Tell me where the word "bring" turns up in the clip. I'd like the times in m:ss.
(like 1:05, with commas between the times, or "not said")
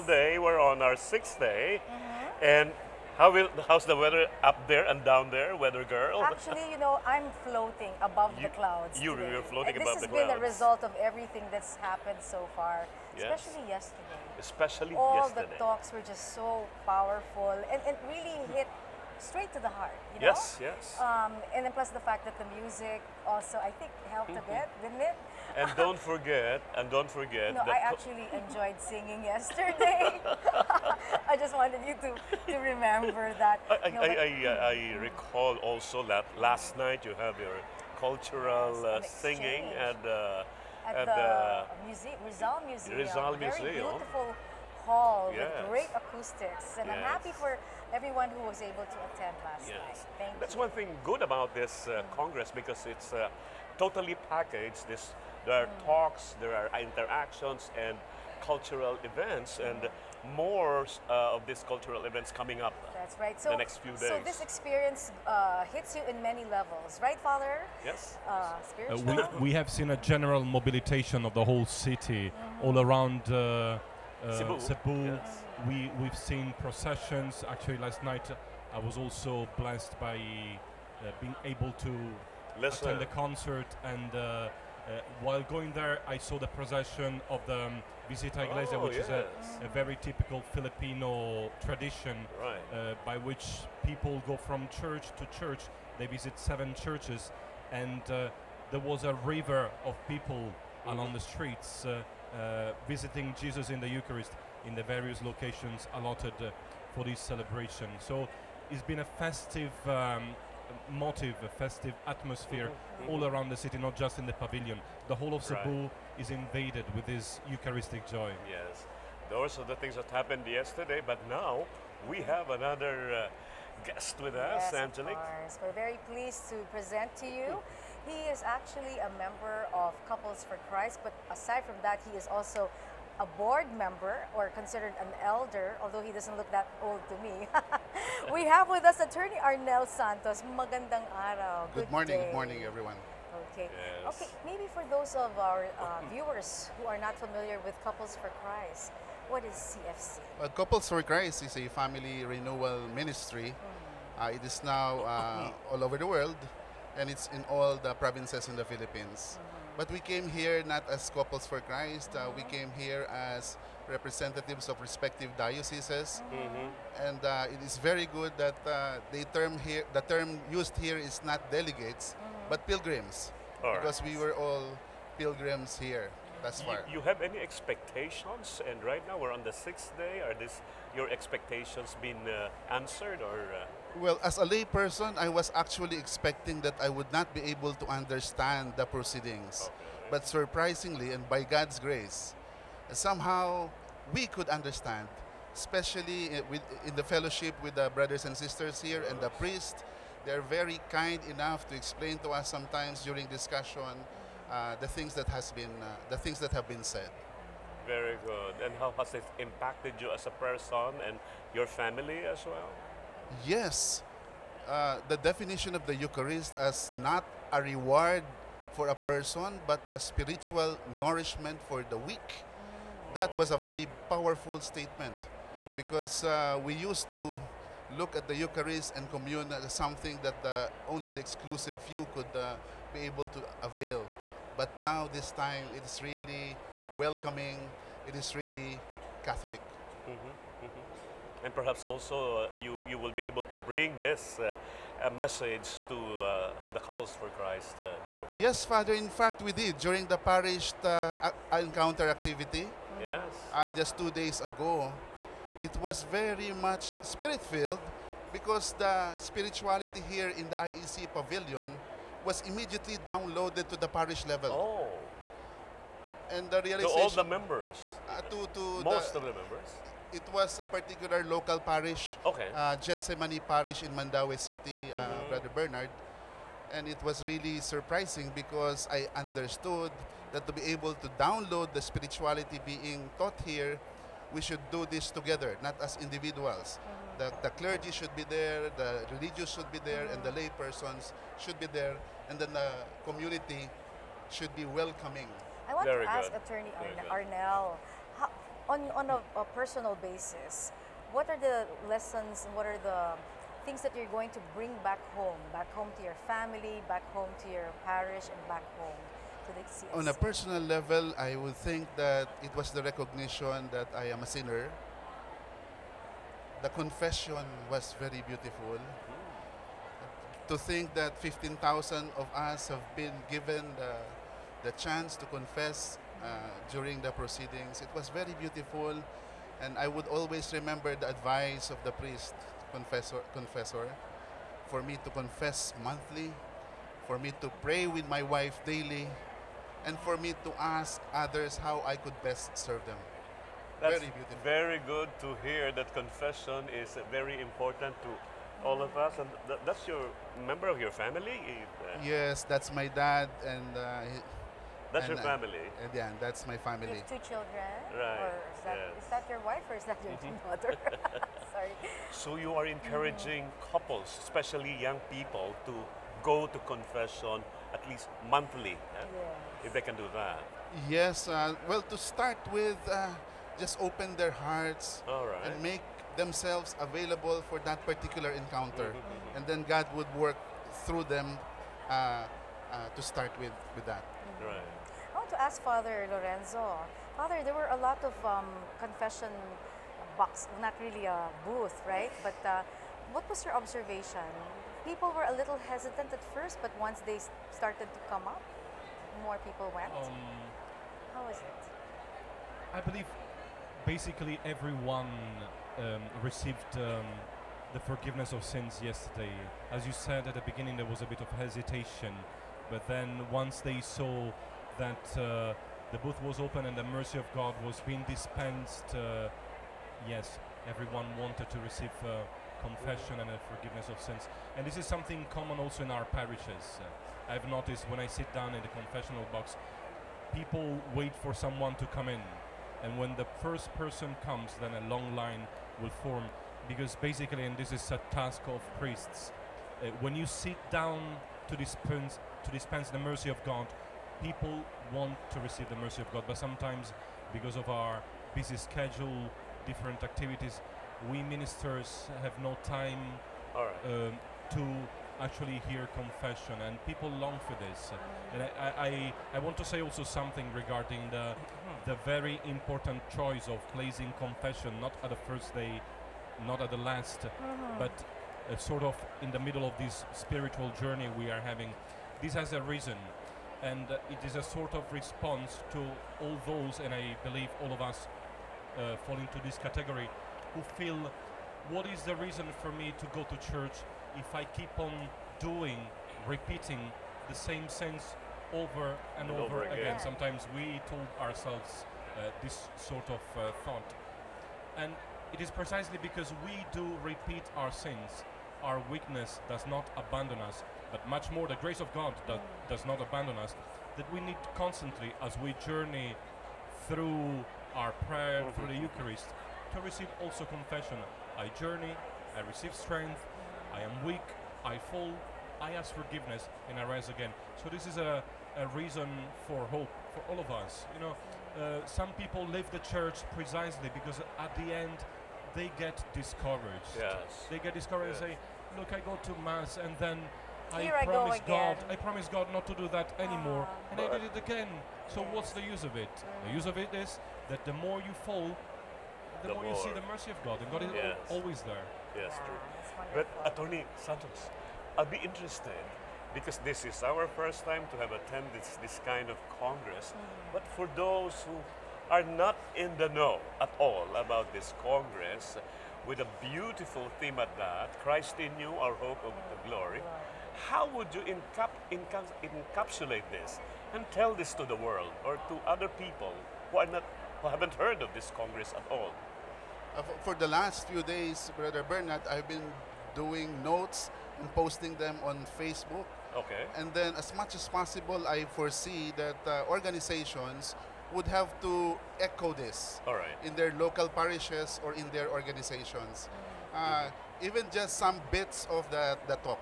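4:03, 5:04.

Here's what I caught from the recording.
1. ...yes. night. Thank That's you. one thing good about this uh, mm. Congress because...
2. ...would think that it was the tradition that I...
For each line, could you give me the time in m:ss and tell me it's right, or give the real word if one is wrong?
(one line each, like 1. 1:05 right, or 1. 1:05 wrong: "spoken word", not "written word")
1. 0:49 right
2. 5:11 wrong: "recognition", not "tradition".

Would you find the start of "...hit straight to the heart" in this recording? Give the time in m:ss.
0:18.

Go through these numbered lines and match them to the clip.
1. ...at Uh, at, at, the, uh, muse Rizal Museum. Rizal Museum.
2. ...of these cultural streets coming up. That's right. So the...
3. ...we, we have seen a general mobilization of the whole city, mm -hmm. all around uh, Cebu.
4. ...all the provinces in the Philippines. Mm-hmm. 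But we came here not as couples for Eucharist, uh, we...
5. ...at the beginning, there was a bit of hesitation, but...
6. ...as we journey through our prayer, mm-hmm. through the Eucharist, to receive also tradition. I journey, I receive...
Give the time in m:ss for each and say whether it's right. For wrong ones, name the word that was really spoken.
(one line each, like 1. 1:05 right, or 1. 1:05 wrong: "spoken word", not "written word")
1. 0:39 right
2. 1:01 wrong: "events", not "streets"
3. 1:09 right
4. 2:37 wrong: "Christ", not "Eucharist"
5. 6:50 right
6. 8:25 wrong: "confession", not "tradition".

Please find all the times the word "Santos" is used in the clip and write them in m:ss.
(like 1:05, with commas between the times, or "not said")
2:19, 9:03.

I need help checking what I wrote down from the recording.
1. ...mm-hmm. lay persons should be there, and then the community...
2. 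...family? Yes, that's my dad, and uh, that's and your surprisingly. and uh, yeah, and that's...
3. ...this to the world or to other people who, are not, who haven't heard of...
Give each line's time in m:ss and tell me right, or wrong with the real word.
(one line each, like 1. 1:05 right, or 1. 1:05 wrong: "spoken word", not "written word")
1. 4:50 right
2. 5:50 wrong: "family", not "surprisingly"
3. 9:24 right.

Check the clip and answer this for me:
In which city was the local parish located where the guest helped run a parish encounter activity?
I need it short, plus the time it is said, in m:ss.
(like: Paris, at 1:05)
Mandaue City, at 4:33.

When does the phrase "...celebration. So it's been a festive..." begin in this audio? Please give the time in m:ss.
1:47.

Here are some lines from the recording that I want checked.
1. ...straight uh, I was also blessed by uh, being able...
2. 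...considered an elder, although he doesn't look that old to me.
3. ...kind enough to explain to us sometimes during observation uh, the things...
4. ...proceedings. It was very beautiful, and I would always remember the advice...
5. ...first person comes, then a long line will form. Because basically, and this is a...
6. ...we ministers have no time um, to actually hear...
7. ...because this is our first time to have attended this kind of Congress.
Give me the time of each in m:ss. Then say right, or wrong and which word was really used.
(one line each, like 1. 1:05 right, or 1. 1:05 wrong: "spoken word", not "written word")
1. 1:18 wrong: "night", not "straight"
2. 2:14 right
3. 3:20 wrong: "discussion", not "observation"
4. 5:27 right
5. 7:13 right
6. 7:31 right
7. 9:06 right.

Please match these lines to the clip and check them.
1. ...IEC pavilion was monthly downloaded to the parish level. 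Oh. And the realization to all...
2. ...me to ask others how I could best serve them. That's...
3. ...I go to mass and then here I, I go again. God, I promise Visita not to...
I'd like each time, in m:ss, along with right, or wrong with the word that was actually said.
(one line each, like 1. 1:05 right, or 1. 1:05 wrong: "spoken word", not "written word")
1. 4:20 wrong: "immediately", not "monthly"
2. 5:40 right
3. 8:48 wrong: "God", not "Visita".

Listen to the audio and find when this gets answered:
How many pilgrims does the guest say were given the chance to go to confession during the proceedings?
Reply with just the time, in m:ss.
5:21.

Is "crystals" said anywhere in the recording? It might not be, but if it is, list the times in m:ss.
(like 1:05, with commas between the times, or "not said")
not said.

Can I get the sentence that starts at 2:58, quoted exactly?
And right now we're on the sixth day.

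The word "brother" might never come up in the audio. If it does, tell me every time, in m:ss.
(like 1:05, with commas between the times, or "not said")
3:17, 4:35, 9:31.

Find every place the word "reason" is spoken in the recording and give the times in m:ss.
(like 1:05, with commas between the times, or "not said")
7:52, 8:02, 8:38.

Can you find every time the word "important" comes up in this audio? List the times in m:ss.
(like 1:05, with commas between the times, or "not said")
5:47, 7:42.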